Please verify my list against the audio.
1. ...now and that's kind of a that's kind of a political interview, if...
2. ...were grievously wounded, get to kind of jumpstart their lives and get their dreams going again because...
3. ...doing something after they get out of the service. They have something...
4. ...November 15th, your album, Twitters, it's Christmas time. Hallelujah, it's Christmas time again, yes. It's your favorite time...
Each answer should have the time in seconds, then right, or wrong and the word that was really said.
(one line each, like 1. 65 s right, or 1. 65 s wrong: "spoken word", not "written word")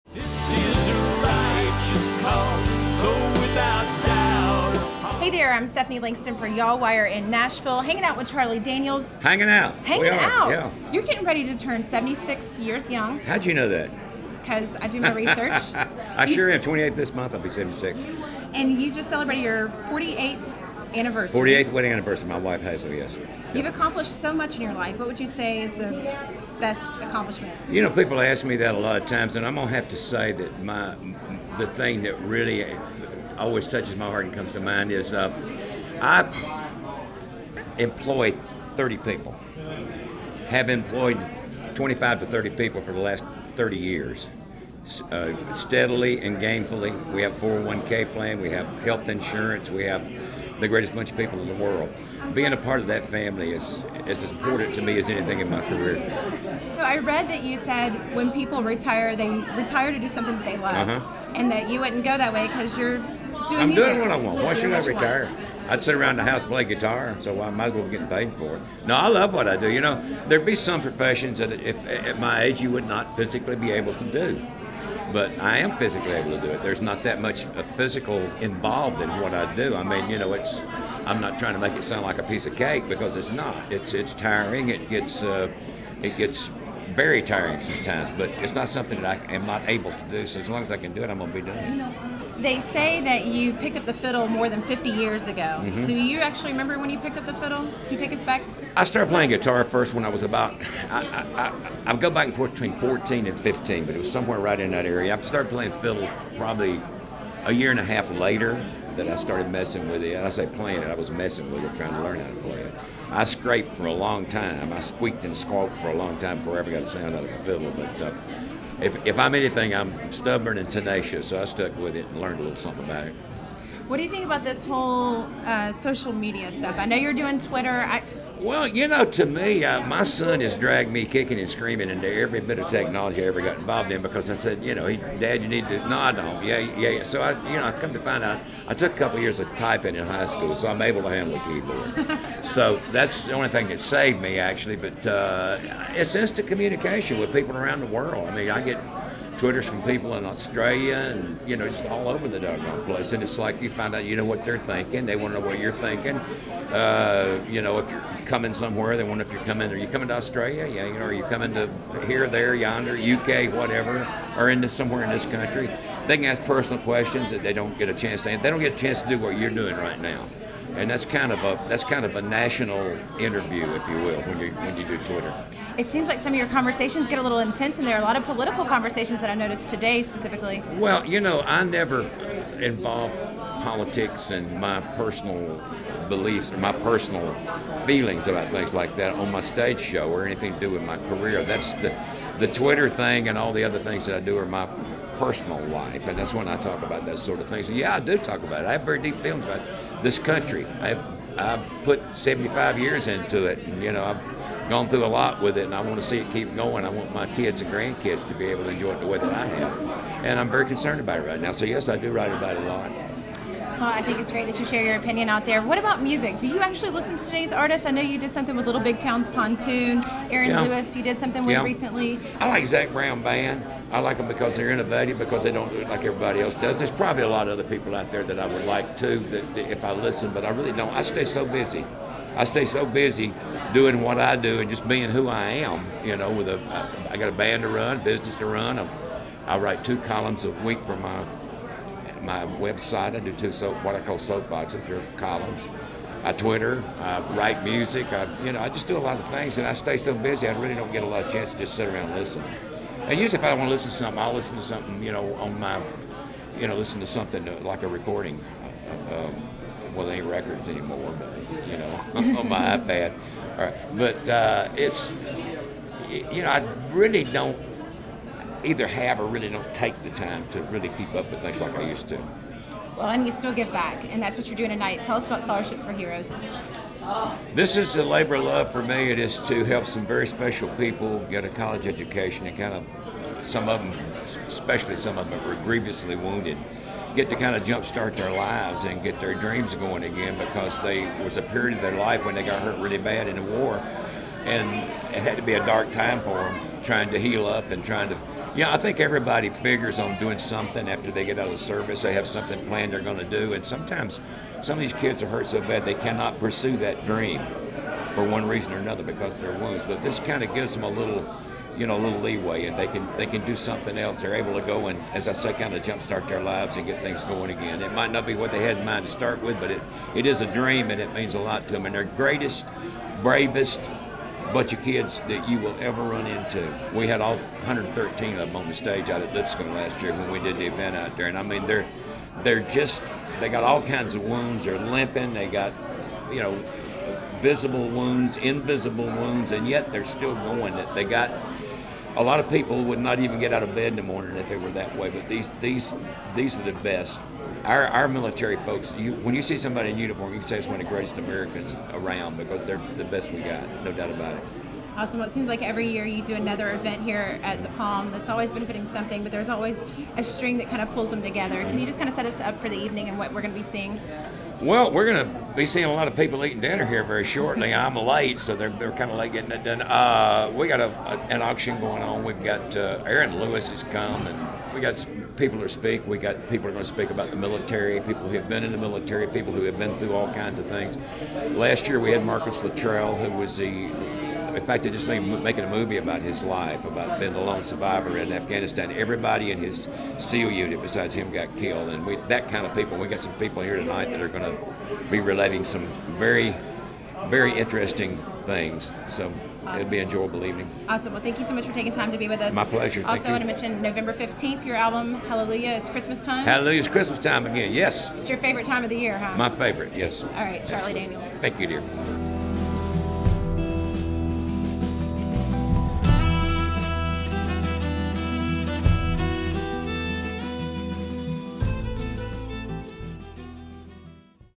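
1. 169 s wrong: "national", not "political"
2. 285 s right
3. 300 s right
4. 403 s wrong: "Hallelujah", not "Twitters".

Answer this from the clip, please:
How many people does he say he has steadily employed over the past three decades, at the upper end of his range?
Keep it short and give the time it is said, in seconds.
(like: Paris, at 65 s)
30, at 41 s.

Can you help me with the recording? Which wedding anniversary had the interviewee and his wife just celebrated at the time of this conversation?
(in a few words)
48th.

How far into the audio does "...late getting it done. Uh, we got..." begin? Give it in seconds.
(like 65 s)
369 s.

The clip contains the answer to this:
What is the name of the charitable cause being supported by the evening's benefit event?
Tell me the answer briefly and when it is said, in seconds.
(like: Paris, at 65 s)
Scholarships for Heroes, at 275 s.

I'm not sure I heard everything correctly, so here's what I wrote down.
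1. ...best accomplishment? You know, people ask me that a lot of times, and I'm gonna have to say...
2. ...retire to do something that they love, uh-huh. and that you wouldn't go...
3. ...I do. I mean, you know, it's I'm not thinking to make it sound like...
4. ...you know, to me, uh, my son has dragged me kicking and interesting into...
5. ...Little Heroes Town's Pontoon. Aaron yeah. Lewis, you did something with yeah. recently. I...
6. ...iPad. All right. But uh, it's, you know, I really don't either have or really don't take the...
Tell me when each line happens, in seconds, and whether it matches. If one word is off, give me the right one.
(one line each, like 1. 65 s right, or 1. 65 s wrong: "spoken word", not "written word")
1. 26 s right
2. 59 s right
3. 79 s wrong: "trying", not "thinking"
4. 128 s wrong: "screaming", not "interesting"
5. 218 s wrong: "Big", not "Heroes"
6. 262 s right.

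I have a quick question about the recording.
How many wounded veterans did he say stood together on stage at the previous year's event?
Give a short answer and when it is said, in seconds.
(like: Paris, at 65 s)
113, at 327 s.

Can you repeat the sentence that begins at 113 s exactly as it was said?
I scraped for a long time.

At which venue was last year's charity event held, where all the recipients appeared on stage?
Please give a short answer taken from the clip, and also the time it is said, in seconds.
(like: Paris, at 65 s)
Lipscomb, at 329 s.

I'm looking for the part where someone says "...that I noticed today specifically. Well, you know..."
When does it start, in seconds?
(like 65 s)
179 s.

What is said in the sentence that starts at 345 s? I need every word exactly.
But these these these are the best.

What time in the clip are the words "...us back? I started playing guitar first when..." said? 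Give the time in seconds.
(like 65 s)
98 s.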